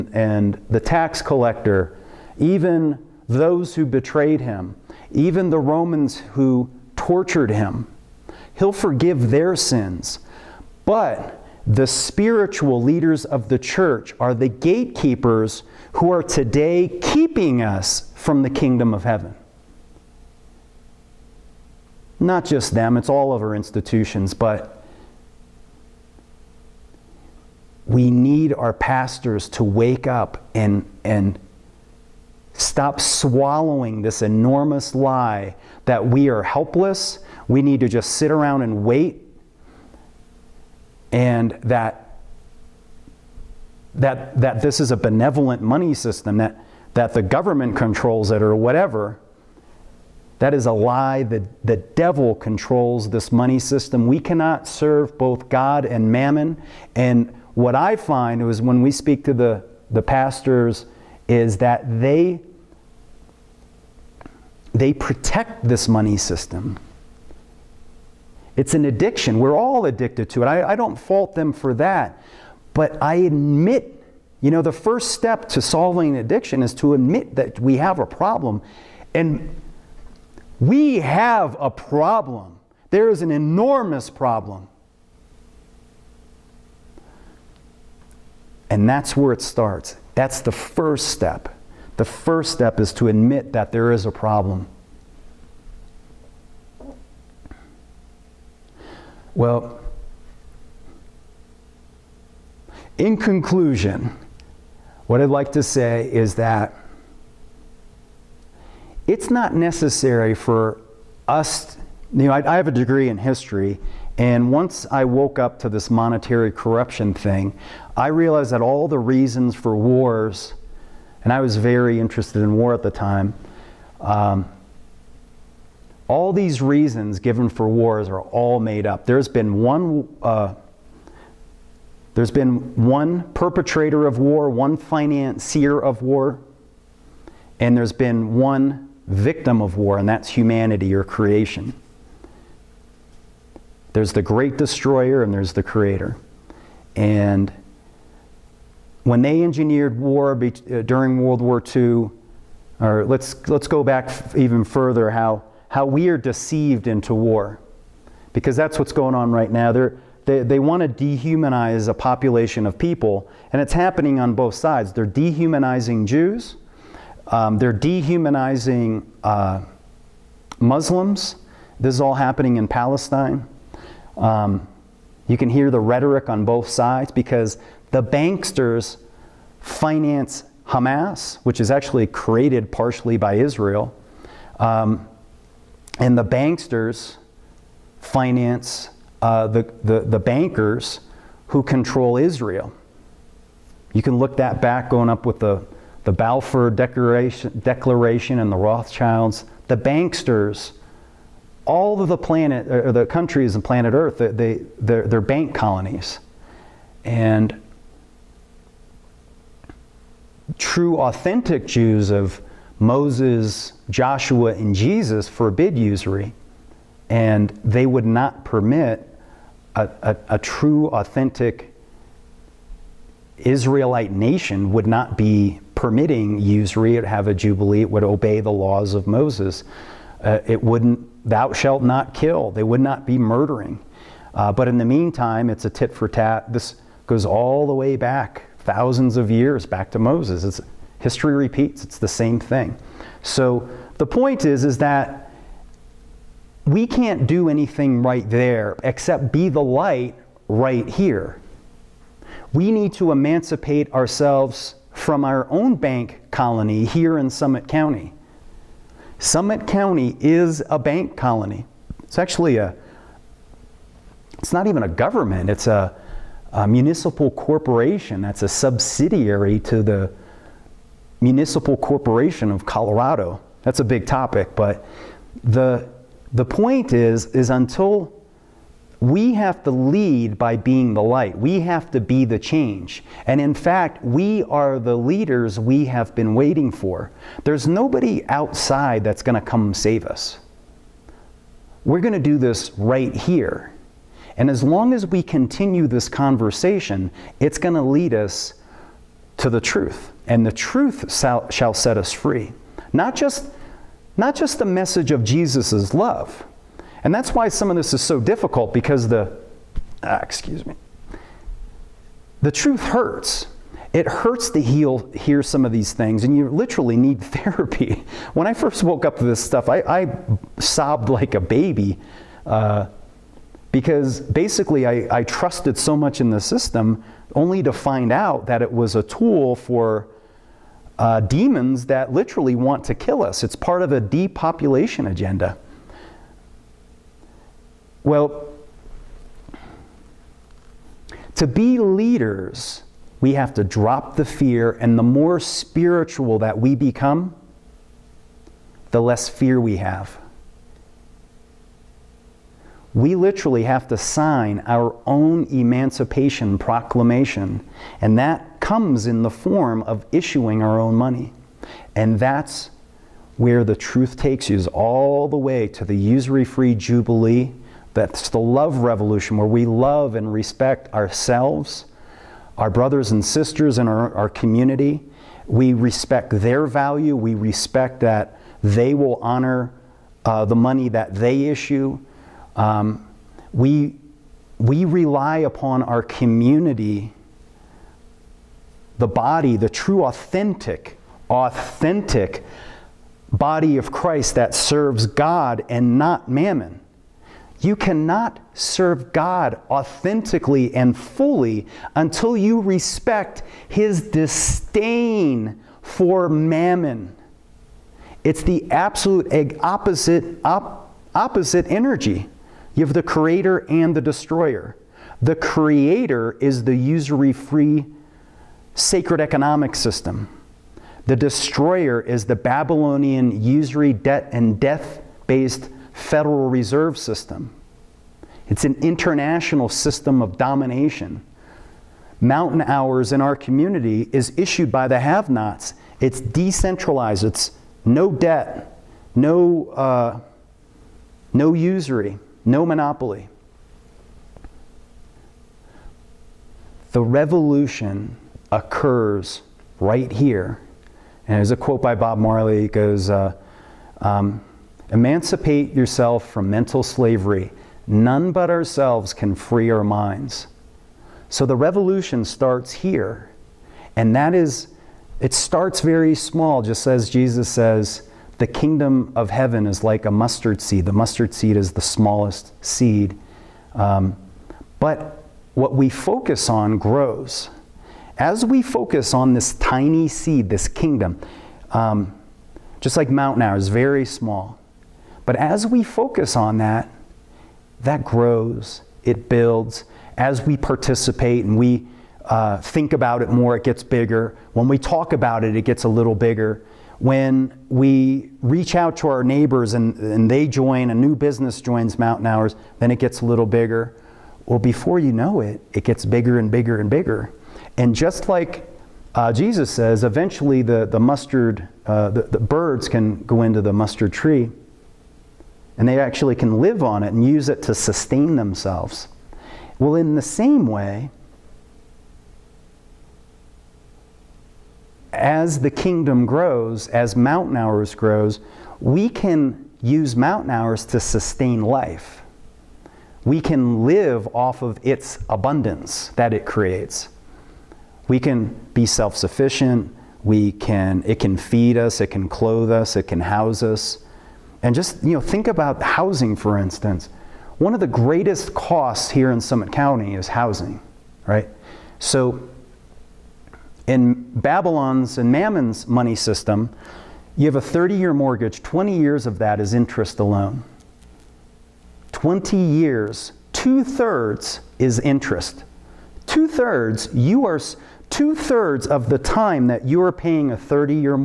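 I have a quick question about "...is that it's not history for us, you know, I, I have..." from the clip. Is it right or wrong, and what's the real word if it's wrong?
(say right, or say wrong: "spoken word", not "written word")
wrong: "necessary", not "history".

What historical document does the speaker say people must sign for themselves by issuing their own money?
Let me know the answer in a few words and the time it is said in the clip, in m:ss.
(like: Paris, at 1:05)
Emancipation Proclamation, at 5:55.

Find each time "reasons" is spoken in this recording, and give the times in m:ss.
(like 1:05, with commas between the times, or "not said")
1:58, 2:06.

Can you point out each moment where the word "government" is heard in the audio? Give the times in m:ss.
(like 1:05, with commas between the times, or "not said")
0:47, 4:24.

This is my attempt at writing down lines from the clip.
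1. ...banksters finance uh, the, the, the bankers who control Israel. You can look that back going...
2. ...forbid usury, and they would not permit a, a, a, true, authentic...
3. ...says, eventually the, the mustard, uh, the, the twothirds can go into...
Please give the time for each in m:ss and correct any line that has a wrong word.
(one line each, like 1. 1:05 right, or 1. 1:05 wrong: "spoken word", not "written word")
1. 3:06 right
2. 3:35 right
3. 8:29 wrong: "birds", not "twothirds".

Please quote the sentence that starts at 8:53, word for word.
We can live off of its abundance that it creates.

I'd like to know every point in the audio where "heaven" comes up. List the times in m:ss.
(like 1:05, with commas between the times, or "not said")
0:19, 7:49.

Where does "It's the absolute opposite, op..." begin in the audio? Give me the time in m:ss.
6:48.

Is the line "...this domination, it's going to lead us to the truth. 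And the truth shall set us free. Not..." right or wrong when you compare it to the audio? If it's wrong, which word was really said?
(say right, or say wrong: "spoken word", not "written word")
wrong: "conversation", not "domination".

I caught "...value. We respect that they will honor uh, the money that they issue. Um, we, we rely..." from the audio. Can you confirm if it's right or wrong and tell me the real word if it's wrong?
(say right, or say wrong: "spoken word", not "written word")
right.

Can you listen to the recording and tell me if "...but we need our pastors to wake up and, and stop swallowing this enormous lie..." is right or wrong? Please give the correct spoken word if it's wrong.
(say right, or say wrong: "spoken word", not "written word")
right.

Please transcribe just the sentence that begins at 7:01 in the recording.
The destroyer is the Babylonian usury, debt, and death based Federal Reserve System.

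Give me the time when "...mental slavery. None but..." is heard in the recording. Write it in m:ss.
7:36.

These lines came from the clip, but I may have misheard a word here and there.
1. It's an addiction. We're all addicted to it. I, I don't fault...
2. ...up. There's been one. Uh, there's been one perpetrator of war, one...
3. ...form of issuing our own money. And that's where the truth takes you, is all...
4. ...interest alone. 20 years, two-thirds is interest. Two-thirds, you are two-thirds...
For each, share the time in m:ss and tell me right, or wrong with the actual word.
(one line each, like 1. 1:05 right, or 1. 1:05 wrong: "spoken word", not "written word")
1. 1:08 right
2. 2:08 right
3. 5:59 right
4. 9:19 right.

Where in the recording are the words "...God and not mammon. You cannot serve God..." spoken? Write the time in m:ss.
6:35.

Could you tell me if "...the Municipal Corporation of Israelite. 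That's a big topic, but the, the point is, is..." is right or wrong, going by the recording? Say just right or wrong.
wrong.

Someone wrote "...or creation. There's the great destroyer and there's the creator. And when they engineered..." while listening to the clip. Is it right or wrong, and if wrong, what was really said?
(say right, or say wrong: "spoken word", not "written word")
right.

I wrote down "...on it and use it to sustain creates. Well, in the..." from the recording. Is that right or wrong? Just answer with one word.
wrong.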